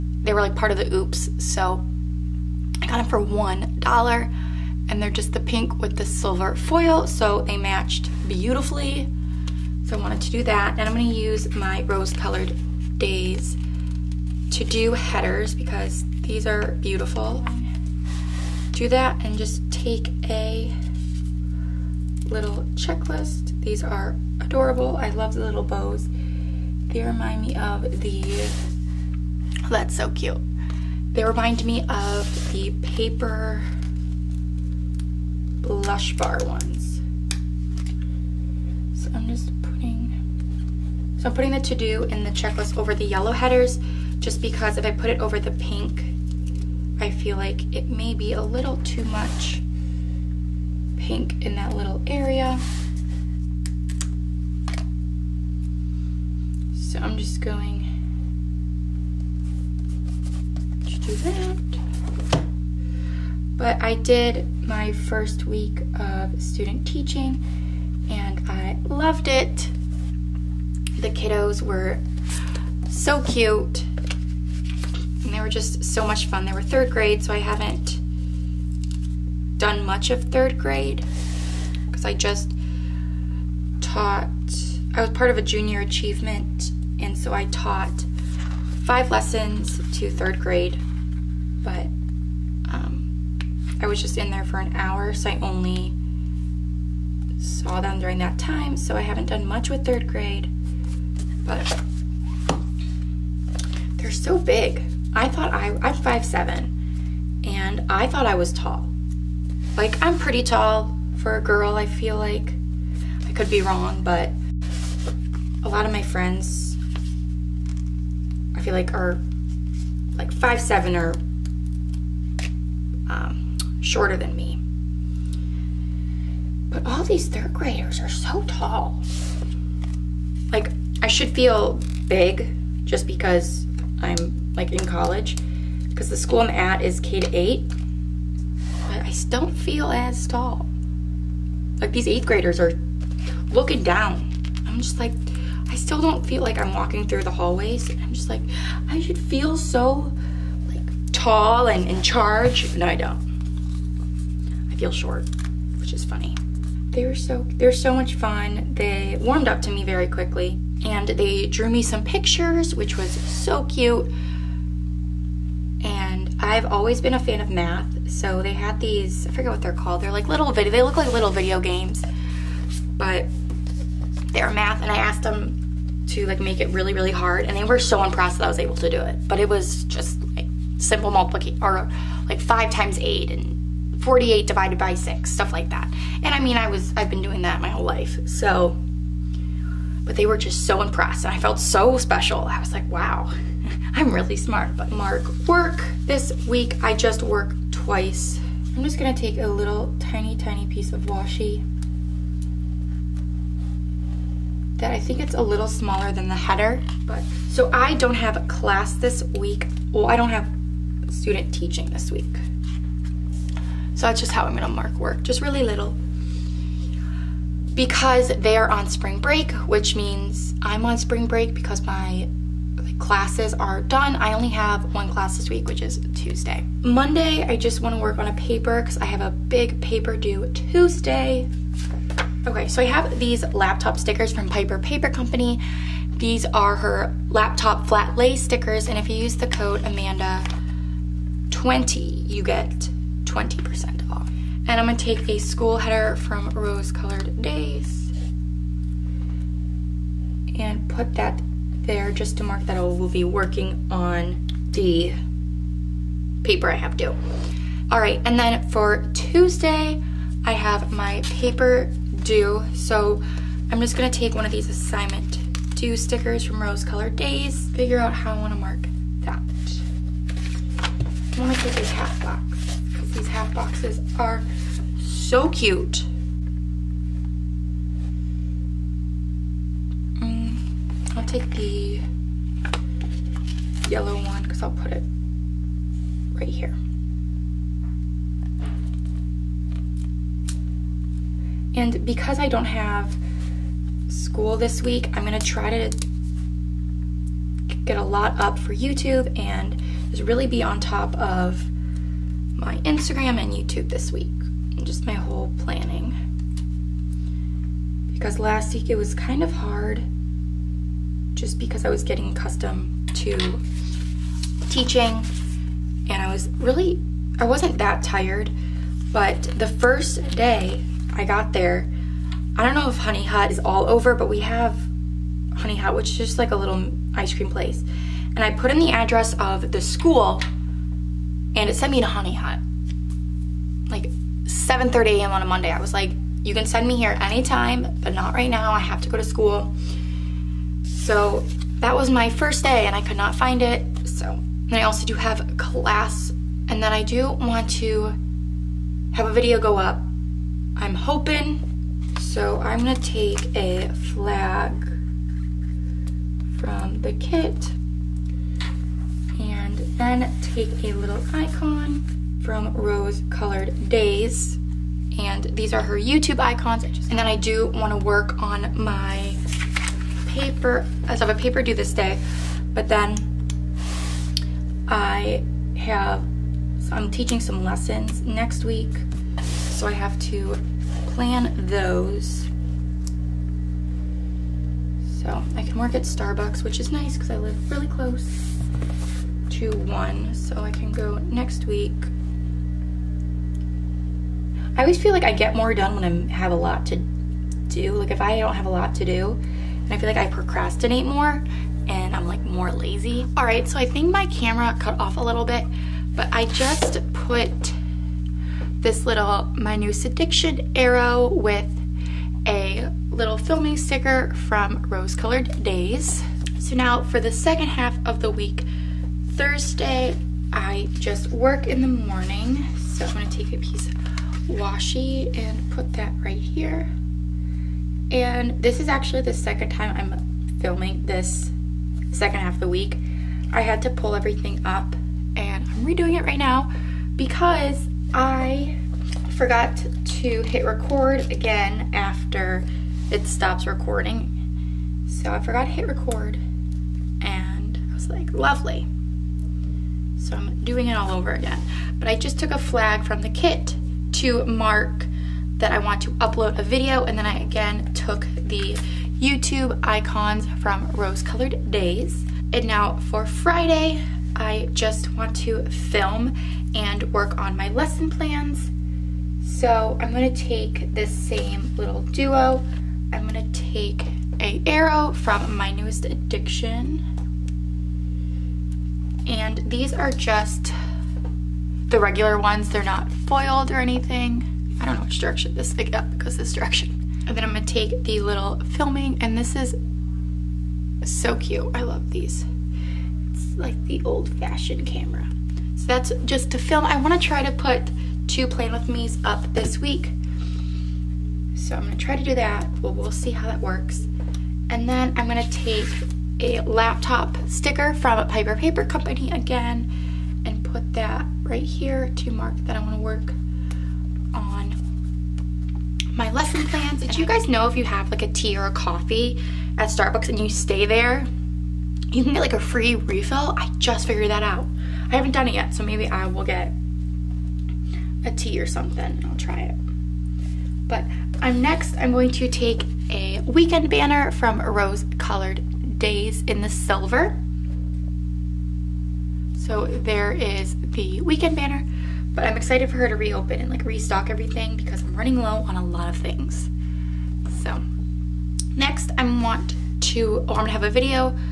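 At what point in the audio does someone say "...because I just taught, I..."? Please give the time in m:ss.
1:21.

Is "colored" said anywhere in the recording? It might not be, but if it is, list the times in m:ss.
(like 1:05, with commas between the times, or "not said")
0:11, 4:06, 4:26, 6:03, 6:55, 7:41, 8:55.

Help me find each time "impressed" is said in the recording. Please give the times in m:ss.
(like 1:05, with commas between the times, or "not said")
2:58, 3:10.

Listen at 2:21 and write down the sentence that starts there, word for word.
Like these 8th graders are looking down.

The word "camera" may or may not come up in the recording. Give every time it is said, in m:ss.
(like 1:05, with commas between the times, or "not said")
6:44, 8:14.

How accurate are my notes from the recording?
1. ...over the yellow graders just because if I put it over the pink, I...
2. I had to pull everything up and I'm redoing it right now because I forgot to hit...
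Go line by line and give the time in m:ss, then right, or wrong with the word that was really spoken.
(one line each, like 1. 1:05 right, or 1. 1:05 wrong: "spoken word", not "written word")
1. 0:42 wrong: "headers", not "graders"
2. 7:13 right.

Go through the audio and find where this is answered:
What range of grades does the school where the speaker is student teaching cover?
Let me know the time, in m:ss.
2:16.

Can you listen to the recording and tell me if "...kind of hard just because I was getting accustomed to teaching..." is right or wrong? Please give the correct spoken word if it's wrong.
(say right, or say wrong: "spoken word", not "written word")
right.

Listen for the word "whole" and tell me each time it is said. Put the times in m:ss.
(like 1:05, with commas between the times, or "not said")
3:07, 5:05.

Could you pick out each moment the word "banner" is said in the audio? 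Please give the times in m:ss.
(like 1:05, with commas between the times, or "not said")
8:53, 9:01.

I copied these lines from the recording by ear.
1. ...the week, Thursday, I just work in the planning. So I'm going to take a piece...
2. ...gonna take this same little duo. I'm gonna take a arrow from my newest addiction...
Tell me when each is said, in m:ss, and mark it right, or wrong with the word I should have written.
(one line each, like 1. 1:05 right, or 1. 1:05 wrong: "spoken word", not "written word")
1. 6:58 wrong: "morning", not "planning"
2. 7:50 right.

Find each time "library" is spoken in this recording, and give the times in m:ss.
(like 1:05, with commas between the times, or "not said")
not said.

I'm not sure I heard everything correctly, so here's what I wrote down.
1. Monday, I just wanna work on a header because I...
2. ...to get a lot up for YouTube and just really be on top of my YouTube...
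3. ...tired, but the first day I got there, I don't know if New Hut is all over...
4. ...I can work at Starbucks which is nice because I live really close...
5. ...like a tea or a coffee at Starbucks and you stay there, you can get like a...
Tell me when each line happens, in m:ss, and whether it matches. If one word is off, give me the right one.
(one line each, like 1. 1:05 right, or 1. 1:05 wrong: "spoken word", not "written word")
1. 3:46 wrong: "paper", not "header"
2. 4:55 wrong: "Instagram", not "YouTube"
3. 5:18 wrong: "Honey", not "New"
4. 6:25 right
5. 8:38 right.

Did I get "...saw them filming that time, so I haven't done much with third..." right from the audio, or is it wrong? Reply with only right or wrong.
wrong.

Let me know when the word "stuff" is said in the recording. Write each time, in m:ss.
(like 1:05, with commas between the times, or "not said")
3:05.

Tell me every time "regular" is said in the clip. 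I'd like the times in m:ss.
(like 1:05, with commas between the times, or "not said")
8:01.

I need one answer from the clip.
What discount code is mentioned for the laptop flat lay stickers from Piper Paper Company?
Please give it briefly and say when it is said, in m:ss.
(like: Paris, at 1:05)
AMANDA20, at 3:59.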